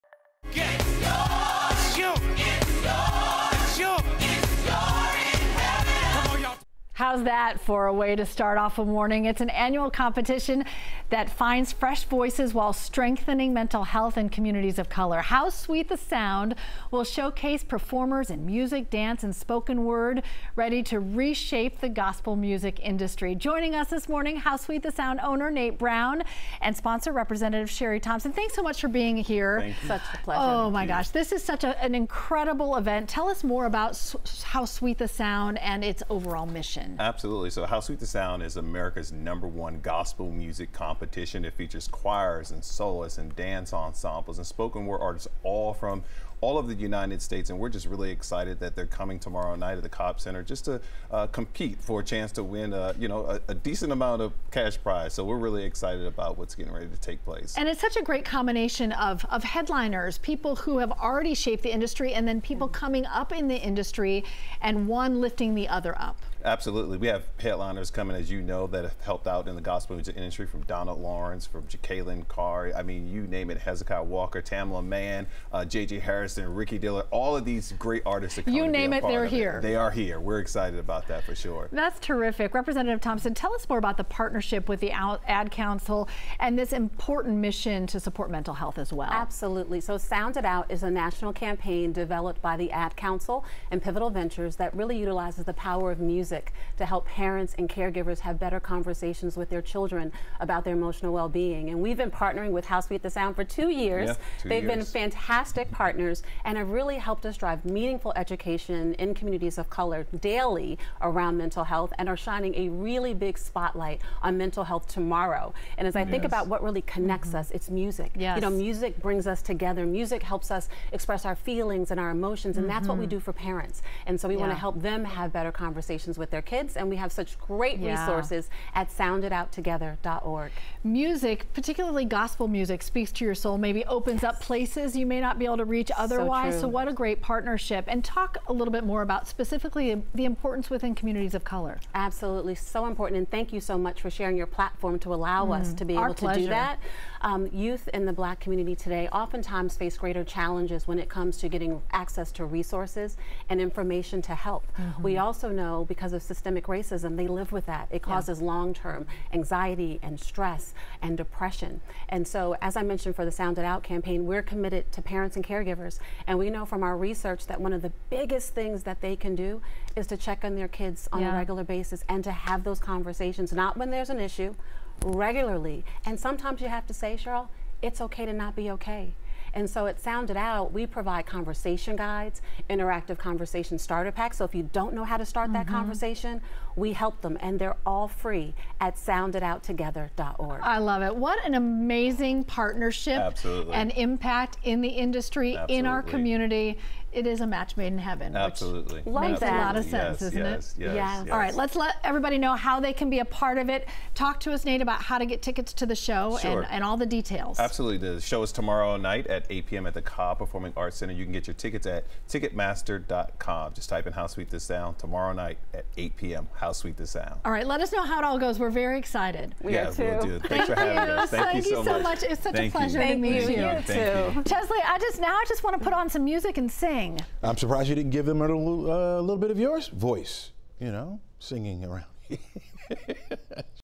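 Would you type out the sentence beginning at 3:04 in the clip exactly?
So if you don't know how to start mm -hmm.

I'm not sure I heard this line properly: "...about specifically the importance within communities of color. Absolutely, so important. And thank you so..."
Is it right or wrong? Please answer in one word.
right.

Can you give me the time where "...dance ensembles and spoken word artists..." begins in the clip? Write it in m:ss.
0:43.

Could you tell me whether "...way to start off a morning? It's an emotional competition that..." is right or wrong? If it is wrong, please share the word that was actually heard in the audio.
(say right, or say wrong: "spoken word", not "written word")
wrong: "annual", not "emotional".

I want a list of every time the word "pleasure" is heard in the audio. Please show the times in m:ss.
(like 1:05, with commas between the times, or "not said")
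0:30, 3:42.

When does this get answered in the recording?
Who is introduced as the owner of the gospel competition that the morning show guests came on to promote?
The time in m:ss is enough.
0:25.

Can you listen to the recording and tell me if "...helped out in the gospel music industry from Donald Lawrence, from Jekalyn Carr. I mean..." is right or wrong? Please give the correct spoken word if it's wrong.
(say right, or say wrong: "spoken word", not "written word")
right.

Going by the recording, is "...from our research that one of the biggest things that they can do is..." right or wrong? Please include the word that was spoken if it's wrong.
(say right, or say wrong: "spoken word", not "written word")
right.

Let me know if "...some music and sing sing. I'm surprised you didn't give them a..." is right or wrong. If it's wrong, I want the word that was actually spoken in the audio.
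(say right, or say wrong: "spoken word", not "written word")
right.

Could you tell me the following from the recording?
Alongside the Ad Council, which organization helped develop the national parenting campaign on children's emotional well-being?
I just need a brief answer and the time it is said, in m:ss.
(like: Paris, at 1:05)
Pivotal Ventures, at 1:33.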